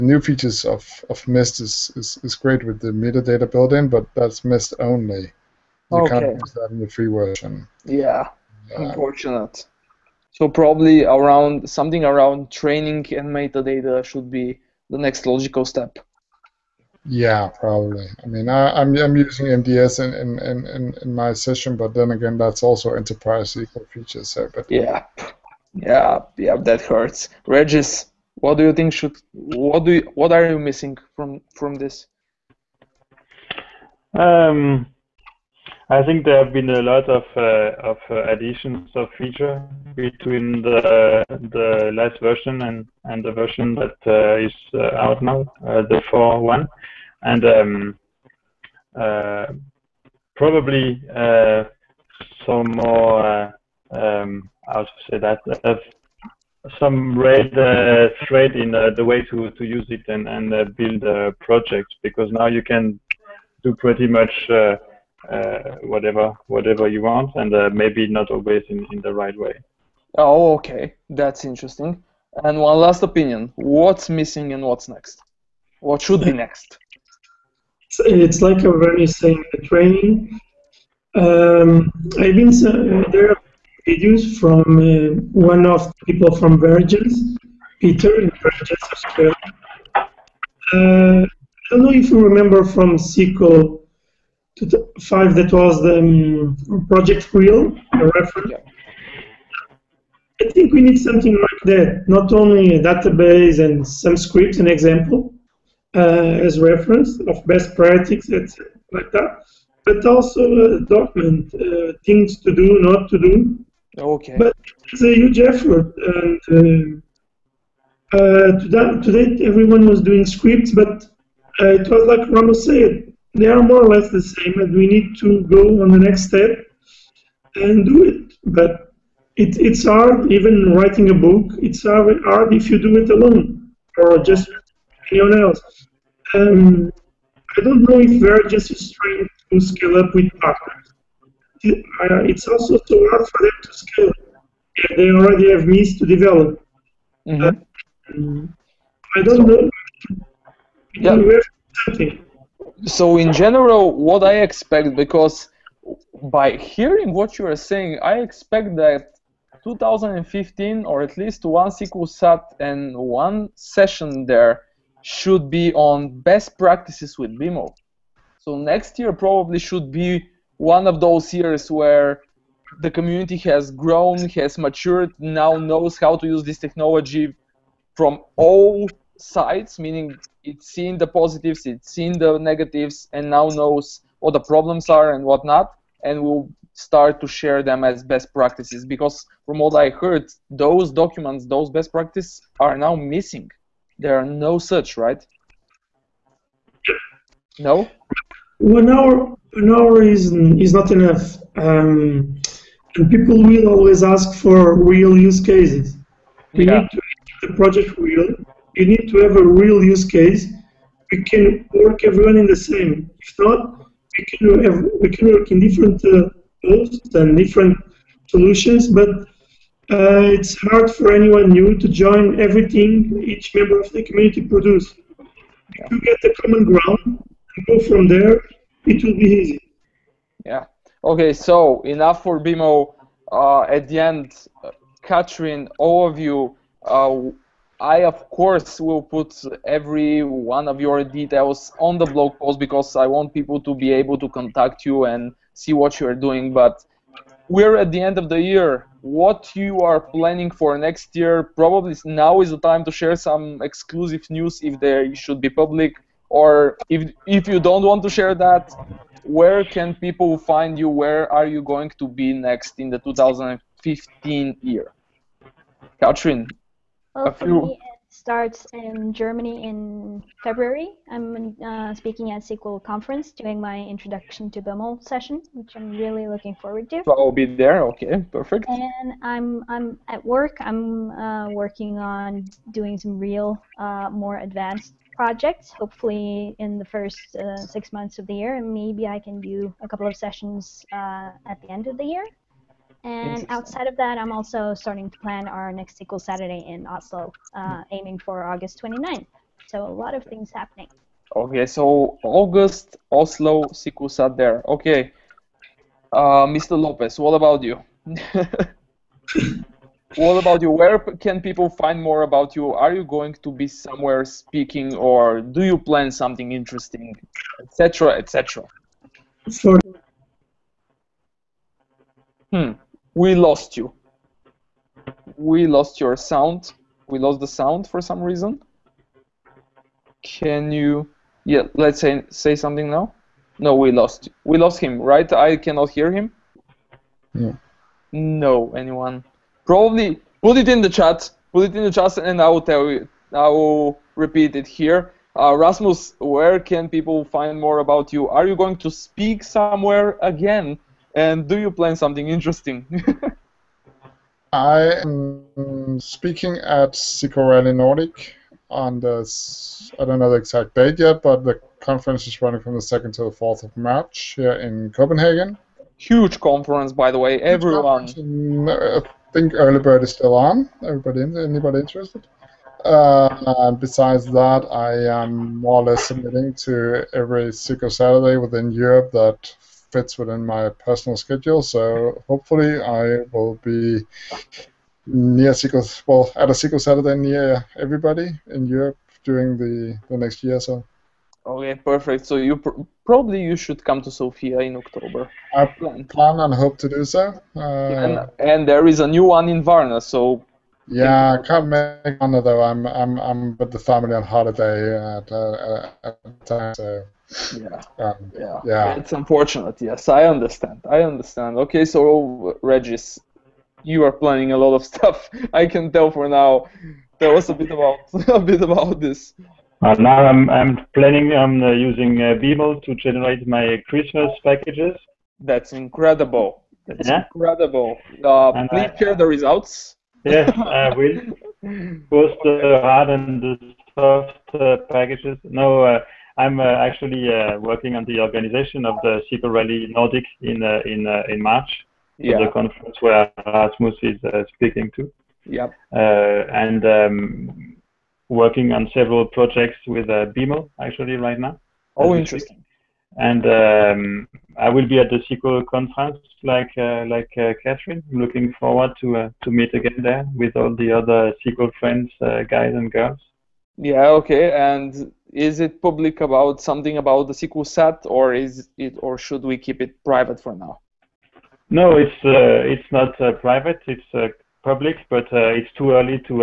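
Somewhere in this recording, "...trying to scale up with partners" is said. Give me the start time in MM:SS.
02:18.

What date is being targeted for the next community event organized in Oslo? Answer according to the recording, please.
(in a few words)
August 29.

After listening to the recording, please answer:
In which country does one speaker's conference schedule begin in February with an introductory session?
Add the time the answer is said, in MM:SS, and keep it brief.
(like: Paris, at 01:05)
Germany, at 04:29.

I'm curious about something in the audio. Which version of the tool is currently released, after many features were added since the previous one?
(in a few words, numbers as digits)
4.1.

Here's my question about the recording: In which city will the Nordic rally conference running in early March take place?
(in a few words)
Copenhagen.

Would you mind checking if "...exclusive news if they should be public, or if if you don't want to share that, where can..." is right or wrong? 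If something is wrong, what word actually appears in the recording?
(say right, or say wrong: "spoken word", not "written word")
right.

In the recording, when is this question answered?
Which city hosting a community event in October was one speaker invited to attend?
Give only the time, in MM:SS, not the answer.
06:34.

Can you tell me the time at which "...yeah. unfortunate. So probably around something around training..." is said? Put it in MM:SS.
00:08.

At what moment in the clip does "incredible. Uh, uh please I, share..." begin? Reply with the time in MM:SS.
07:07.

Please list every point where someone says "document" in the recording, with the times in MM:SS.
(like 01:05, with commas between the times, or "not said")
01:50, 03:10.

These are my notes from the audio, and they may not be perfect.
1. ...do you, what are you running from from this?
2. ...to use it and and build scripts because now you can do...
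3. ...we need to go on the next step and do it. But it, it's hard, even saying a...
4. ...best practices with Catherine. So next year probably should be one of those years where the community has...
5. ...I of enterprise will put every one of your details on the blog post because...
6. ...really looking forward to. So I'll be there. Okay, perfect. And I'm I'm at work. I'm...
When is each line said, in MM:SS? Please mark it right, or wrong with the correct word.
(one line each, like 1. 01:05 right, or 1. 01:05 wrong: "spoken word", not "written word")
1. 00:29 wrong: "missing", not "running"
2. 00:59 wrong: "projects", not "scripts"
3. 02:04 wrong: "writing", not "saying"
4. 02:46 wrong: "BIML", not "Catherine"
5. 03:57 wrong: "course", not "enterprise"
6. 04:35 right.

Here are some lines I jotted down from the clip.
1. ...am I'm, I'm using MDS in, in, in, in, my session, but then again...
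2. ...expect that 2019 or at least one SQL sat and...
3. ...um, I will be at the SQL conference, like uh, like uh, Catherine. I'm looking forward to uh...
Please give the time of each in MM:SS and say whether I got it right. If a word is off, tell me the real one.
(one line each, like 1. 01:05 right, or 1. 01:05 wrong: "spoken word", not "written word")
1. 00:18 right
2. 02:38 wrong: "2015", not "2019"
3. 07:33 right.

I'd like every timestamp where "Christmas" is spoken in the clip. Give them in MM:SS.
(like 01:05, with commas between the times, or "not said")
07:03.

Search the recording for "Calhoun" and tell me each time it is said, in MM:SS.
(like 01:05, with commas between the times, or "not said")
not said.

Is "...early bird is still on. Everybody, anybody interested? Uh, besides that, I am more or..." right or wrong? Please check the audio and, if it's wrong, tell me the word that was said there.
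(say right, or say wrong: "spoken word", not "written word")
right.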